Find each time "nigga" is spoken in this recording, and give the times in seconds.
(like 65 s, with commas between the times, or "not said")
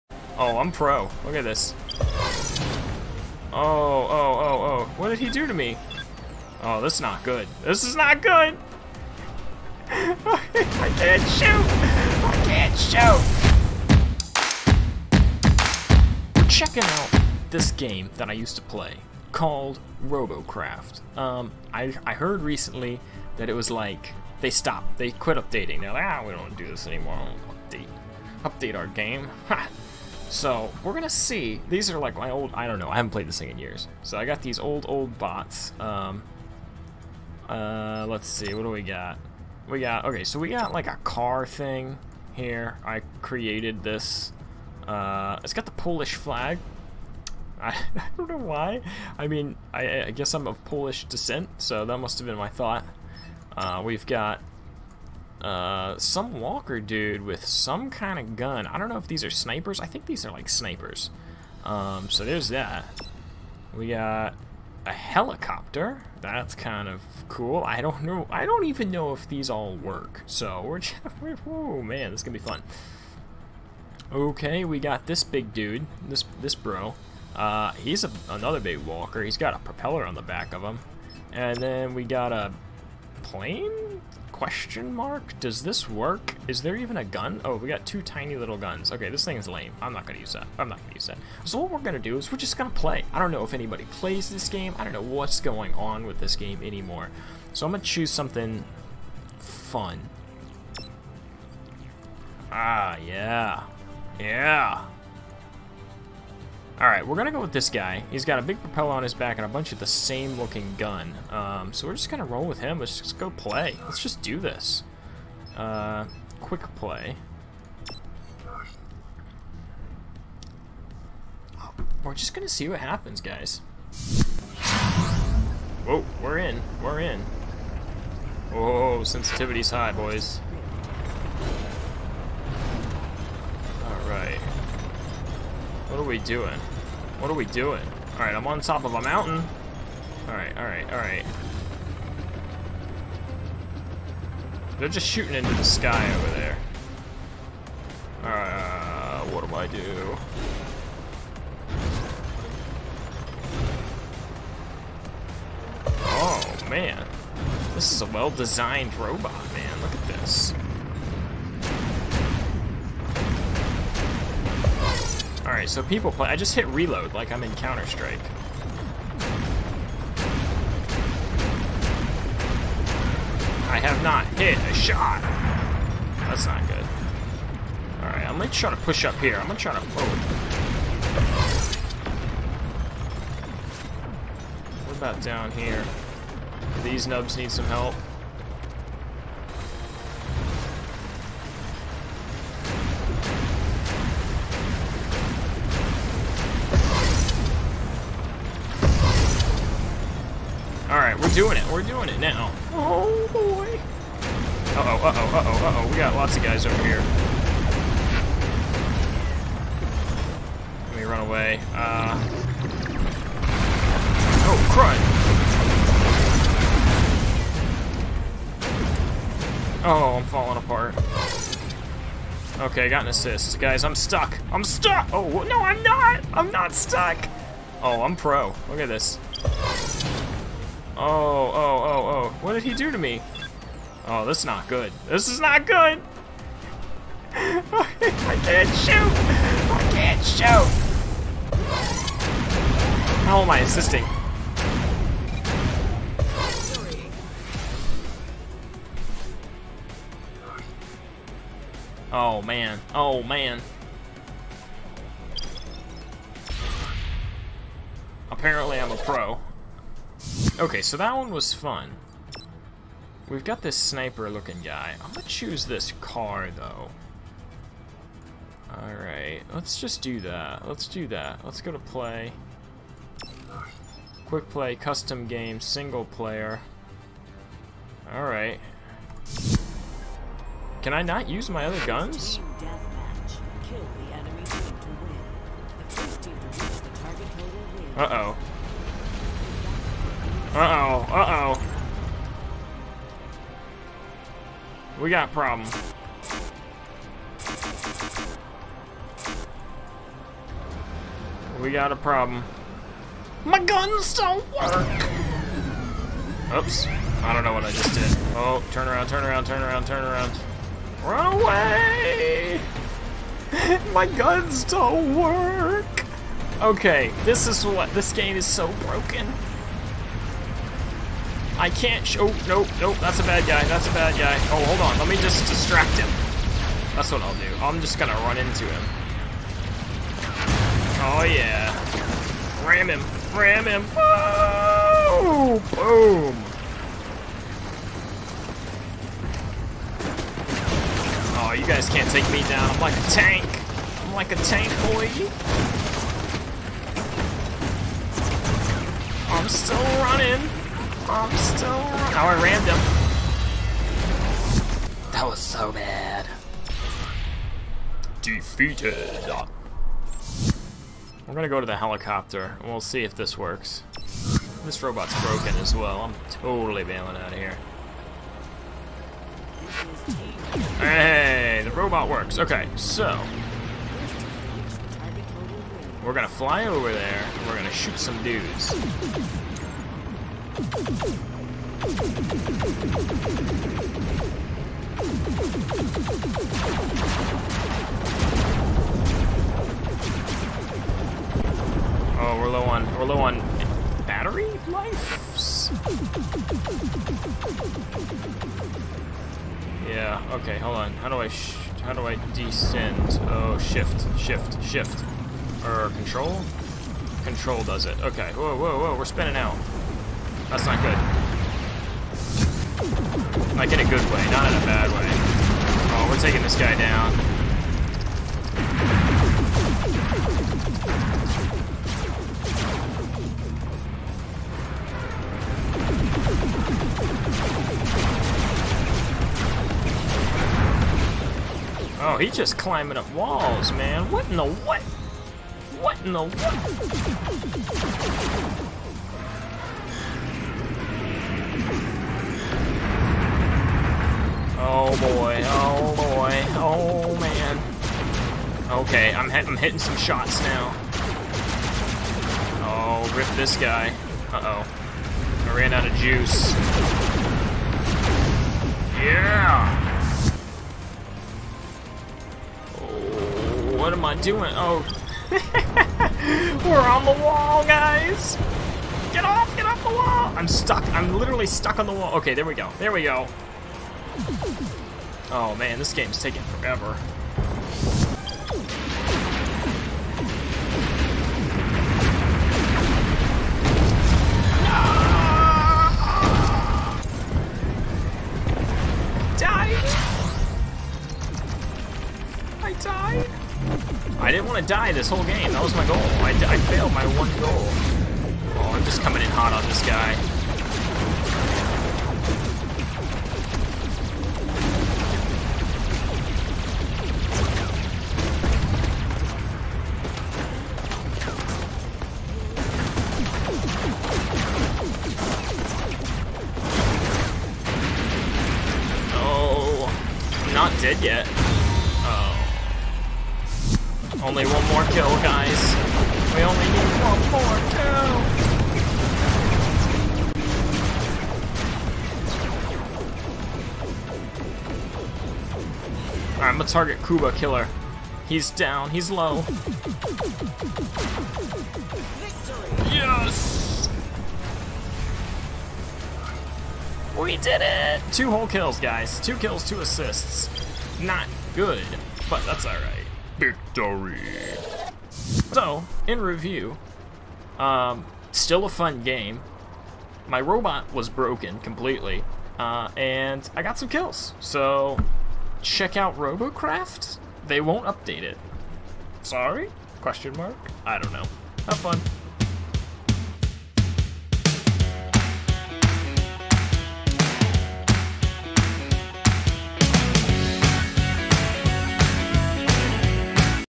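not said.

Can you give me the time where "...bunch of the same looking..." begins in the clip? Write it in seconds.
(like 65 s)
109 s.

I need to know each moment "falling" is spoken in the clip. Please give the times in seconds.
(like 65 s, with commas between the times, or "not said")
220 s.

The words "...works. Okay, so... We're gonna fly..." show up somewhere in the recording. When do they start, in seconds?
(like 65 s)
372 s.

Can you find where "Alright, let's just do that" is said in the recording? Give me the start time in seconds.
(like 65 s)
268 s.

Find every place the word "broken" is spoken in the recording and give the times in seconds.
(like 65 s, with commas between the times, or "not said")
318 s, 365 s, 561 s.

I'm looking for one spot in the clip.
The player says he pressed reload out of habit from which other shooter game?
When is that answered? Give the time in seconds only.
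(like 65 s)
167 s.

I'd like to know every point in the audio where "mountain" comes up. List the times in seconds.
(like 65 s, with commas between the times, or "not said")
139 s.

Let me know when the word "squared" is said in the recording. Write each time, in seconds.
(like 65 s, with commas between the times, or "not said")
not said.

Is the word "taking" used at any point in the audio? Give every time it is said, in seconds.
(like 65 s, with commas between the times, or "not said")
416 s, 476 s.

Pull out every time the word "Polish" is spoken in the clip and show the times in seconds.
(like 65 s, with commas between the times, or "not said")
45 s, 50 s.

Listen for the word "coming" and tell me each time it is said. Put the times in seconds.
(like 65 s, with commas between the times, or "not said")
499 s.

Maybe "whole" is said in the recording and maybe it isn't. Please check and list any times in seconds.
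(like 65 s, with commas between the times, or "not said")
495 s, 548 s.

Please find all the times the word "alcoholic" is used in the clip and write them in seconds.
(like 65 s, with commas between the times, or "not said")
not said.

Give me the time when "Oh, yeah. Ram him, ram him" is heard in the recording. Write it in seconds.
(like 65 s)
331 s.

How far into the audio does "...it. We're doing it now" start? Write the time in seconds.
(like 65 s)
201 s.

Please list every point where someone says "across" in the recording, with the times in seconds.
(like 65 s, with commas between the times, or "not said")
not said.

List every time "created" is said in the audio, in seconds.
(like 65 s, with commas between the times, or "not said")
43 s.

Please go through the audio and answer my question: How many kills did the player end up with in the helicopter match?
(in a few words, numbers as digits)
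2.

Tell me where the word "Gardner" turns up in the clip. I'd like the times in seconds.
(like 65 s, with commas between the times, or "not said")
not said.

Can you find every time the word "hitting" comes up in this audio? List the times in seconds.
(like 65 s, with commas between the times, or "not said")
449 s.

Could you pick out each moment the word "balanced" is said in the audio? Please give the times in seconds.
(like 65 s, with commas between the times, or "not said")
not said.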